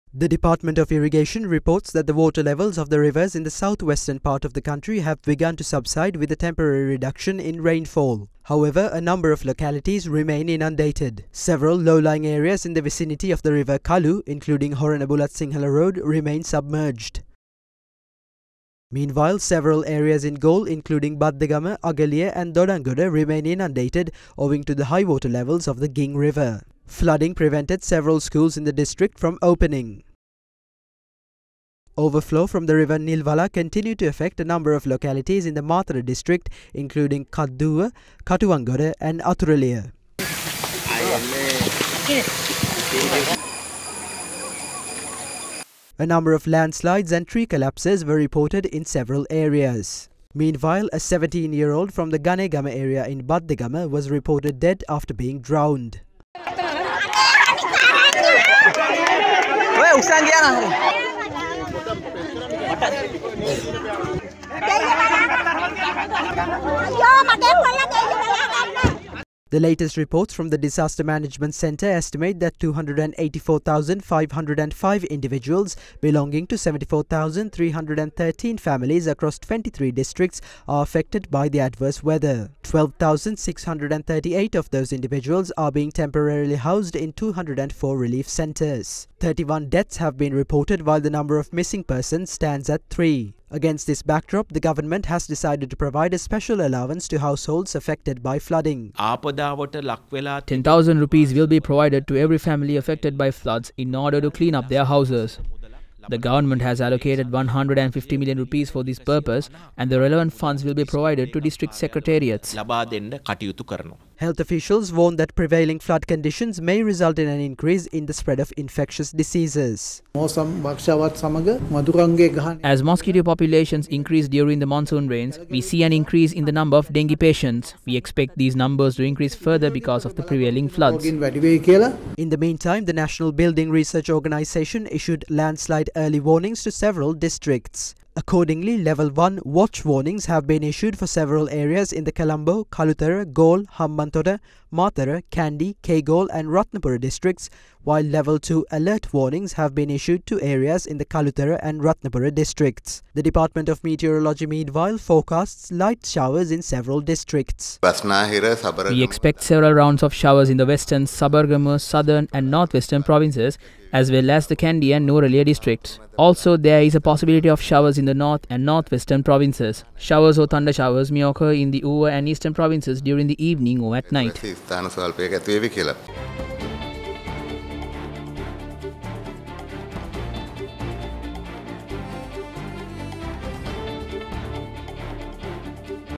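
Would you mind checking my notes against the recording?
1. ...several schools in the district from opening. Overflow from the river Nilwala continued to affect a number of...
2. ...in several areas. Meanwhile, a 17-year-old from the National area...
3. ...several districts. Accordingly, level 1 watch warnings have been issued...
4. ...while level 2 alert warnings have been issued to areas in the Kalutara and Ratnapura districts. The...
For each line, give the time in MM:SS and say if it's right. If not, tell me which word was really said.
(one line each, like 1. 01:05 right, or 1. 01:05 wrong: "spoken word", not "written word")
1. 00:27 right
2. 00:48 wrong: "Ganegama", not "National"
3. 02:16 right
4. 02:27 right.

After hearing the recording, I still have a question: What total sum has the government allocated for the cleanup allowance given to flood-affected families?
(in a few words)
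150 million rupees.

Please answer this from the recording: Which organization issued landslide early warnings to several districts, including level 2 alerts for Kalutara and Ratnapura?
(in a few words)
National Building Research Organization.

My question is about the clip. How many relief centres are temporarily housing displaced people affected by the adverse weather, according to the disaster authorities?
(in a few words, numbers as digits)
204.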